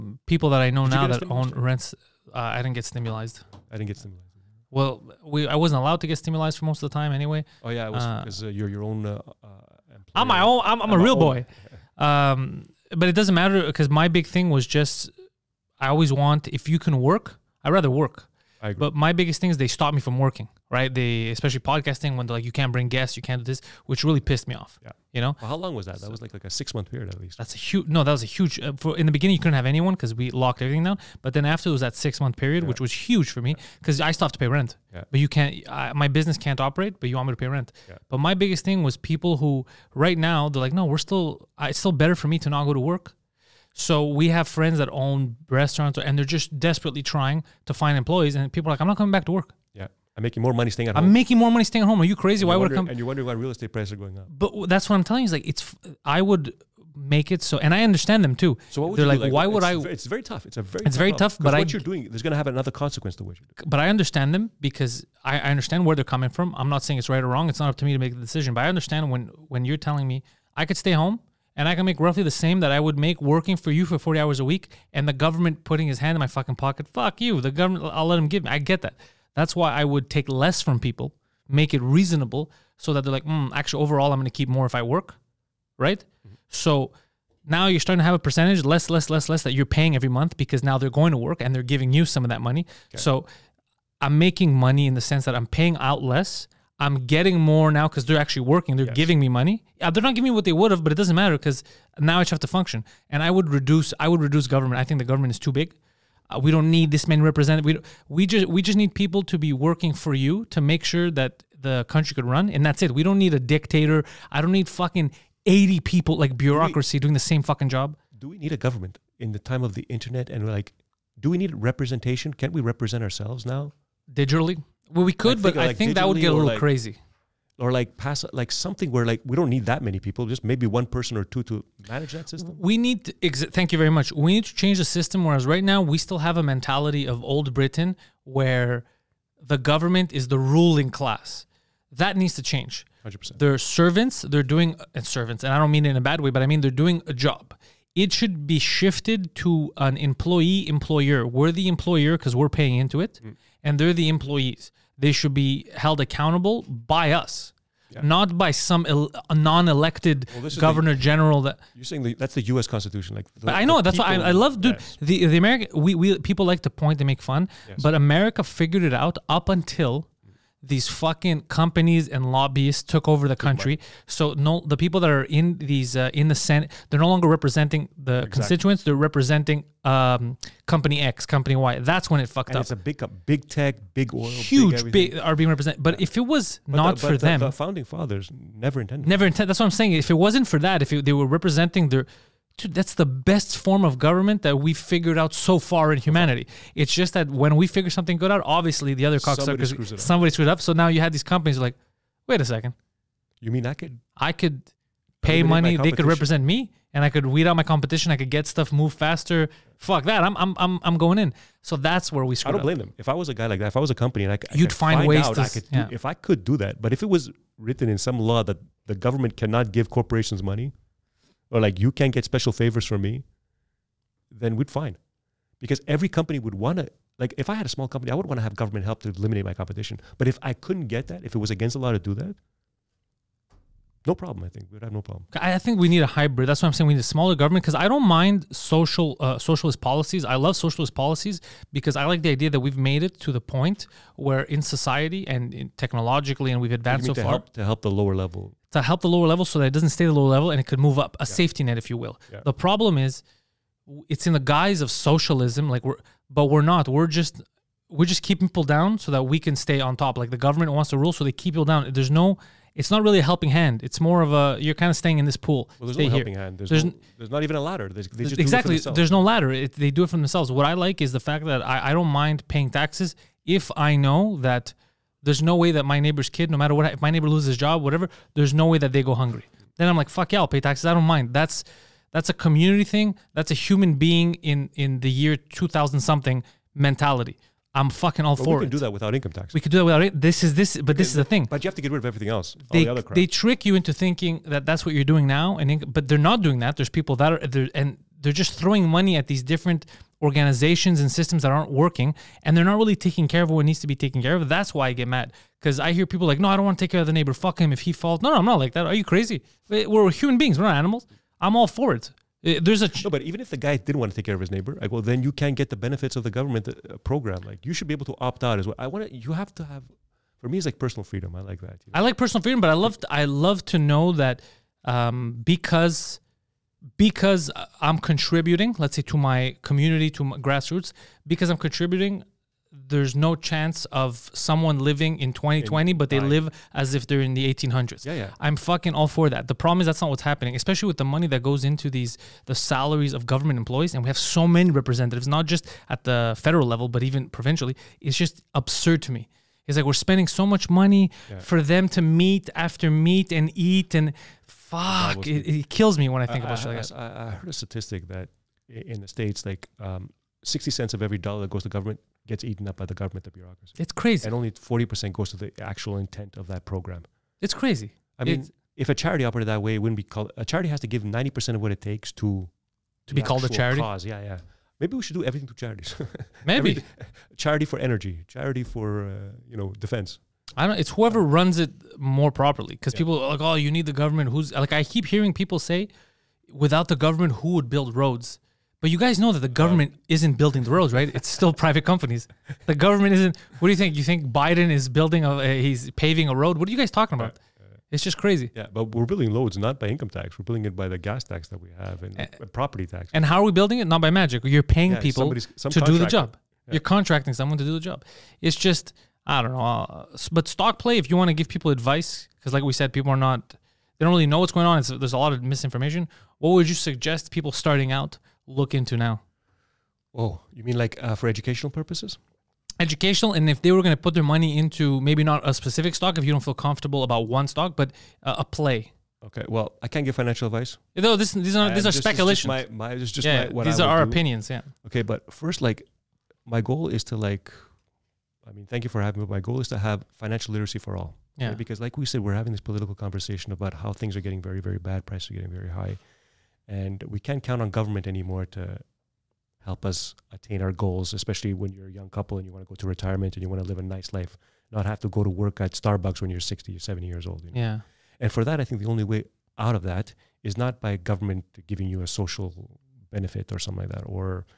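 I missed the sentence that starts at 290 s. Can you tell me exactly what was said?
This is this, but okay, this is the thing.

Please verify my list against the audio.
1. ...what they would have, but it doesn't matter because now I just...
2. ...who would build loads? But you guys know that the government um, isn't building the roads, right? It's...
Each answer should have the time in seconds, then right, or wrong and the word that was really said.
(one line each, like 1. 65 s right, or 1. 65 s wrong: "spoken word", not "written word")
1. 100 s right
2. 387 s wrong: "roads", not "loads".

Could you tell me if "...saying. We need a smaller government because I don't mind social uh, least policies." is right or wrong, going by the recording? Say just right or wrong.
wrong.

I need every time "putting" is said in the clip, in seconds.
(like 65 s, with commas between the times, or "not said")
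75 s.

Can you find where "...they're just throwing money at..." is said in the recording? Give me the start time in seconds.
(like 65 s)
298 s.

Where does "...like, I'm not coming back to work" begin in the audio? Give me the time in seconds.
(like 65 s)
48 s.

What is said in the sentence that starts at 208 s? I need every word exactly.
I could get stuff, move faster.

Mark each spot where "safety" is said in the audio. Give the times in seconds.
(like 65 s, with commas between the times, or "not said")
251 s.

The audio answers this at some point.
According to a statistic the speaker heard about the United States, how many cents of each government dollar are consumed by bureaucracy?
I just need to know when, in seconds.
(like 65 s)
360 s.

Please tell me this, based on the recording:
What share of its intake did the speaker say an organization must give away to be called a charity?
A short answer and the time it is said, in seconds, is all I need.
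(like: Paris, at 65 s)
90 percent, at 371 s.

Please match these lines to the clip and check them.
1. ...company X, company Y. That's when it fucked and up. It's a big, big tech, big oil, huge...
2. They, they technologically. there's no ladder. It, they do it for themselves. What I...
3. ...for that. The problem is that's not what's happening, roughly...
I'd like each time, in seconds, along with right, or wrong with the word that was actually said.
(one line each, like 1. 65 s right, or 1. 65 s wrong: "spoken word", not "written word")
1. 180 s right
2. 267 s wrong: "exactly", not "technologically"
3. 339 s wrong: "especially", not "roughly".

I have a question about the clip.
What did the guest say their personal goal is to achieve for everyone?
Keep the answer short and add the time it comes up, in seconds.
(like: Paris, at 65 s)
financial literacy, at 440 s.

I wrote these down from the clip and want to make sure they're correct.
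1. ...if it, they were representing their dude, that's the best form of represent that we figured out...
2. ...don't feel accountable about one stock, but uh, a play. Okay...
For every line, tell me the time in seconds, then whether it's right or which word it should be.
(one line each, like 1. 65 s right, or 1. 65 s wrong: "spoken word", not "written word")
1. 190 s wrong: "government", not "represent"
2. 426 s wrong: "comfortable", not "accountable".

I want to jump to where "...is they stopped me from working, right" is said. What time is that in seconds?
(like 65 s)
19 s.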